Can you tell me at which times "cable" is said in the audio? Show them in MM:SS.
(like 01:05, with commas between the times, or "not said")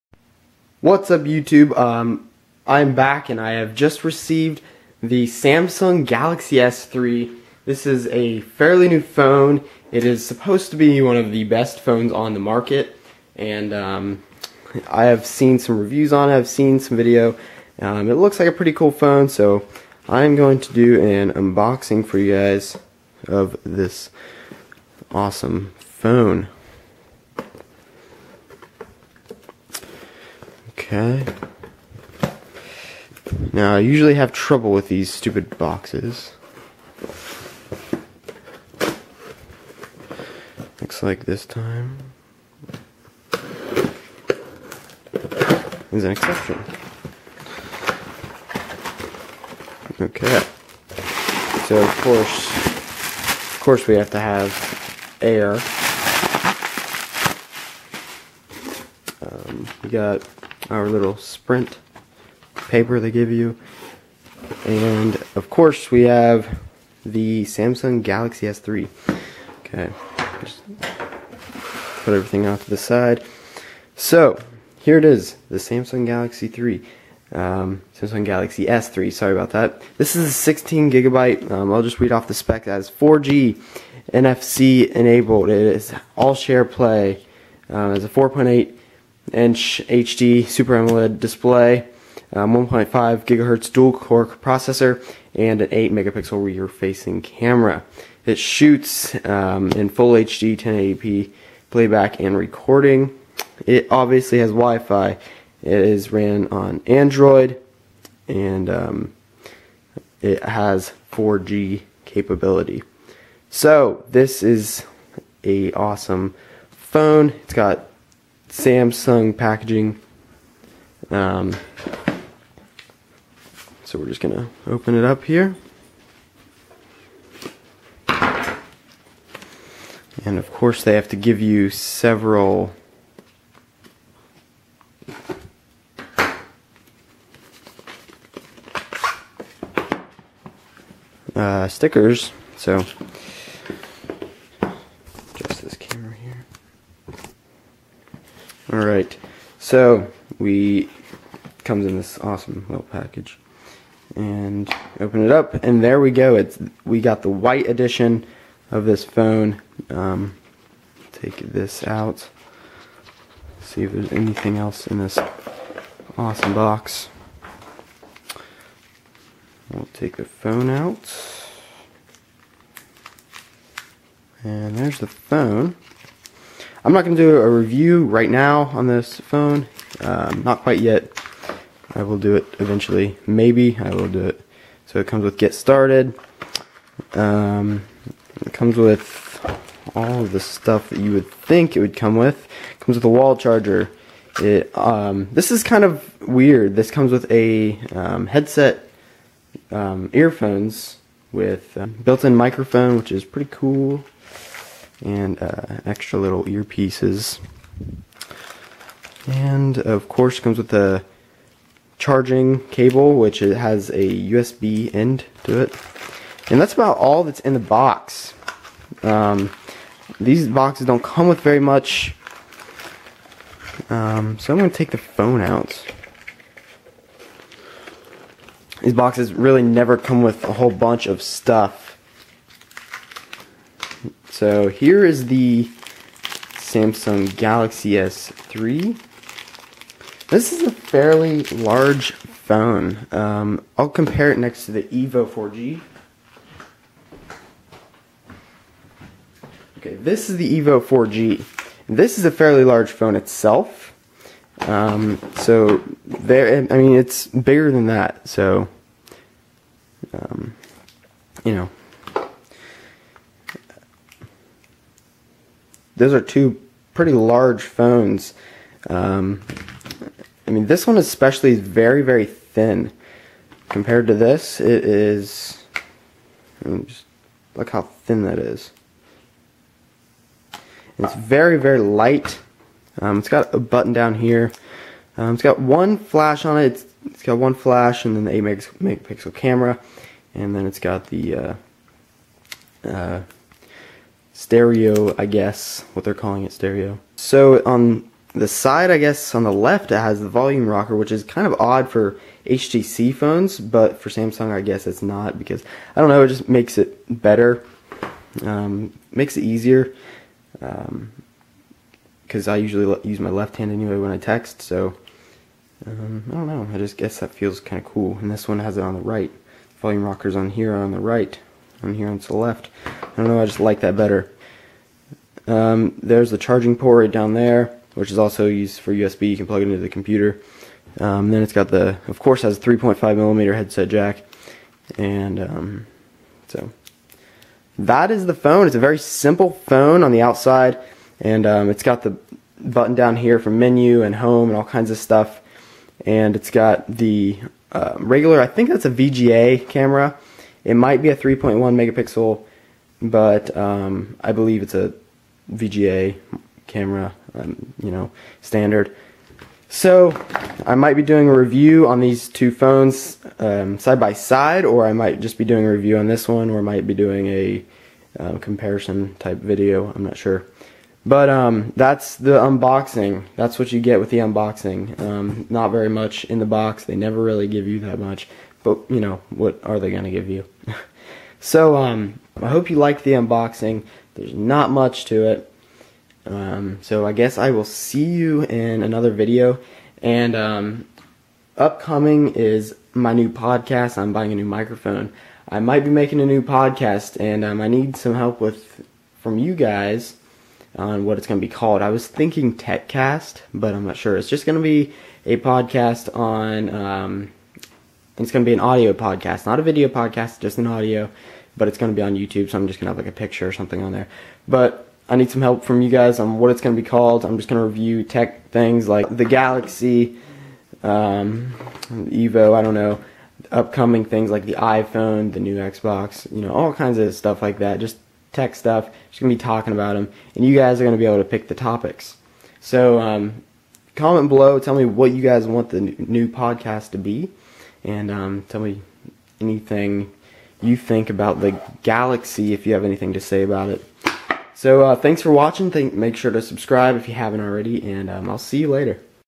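03:32.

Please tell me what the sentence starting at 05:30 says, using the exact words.
Um, then it's got the, of course, has a 3.5 millimeter headset jack, and um, so that is the phone.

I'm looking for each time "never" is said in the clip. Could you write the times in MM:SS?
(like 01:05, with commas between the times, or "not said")
03:49, 06:16.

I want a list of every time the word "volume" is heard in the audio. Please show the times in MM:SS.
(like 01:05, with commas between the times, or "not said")
05:00, 05:19.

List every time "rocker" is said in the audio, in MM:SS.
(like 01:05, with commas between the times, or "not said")
05:00, 05:20.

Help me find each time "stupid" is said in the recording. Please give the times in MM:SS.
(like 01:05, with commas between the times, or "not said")
00:35.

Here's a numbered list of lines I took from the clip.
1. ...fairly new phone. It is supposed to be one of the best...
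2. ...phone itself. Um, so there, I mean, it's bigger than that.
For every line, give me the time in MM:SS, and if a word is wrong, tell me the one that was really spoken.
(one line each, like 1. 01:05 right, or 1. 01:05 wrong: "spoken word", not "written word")
1. 00:08 right
2. 04:12 right.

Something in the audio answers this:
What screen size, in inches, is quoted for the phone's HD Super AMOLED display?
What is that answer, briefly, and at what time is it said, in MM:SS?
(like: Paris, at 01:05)
4.8 inch, at 01:28.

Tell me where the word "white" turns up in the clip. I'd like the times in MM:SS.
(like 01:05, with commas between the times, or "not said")
02:37.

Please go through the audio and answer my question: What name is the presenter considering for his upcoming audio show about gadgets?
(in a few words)
TechCast.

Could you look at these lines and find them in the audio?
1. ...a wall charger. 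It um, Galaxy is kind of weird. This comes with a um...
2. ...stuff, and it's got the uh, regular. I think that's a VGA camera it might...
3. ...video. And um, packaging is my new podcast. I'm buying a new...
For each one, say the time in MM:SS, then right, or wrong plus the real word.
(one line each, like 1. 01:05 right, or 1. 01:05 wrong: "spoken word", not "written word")
1. 03:13 wrong: "This", not "Galaxy"
2. 05:44 right
3. 06:29 wrong: "upcoming", not "packaging".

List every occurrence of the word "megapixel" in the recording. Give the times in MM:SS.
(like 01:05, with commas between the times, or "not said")
01:35, 04:48, 05:51.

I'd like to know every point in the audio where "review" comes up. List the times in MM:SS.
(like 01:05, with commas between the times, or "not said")
00:15, 02:57, 06:01, 06:05, 06:57.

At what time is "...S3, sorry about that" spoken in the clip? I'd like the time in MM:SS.
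01:18.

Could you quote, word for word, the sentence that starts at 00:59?
Um, we got our little sprint paper they give you.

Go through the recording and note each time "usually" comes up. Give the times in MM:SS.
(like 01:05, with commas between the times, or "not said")
00:33, 05:12.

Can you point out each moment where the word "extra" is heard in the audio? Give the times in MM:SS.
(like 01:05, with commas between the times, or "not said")
03:25.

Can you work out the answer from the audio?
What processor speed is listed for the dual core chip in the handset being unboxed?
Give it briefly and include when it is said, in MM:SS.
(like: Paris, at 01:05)
1.5 GHz, at 01:32.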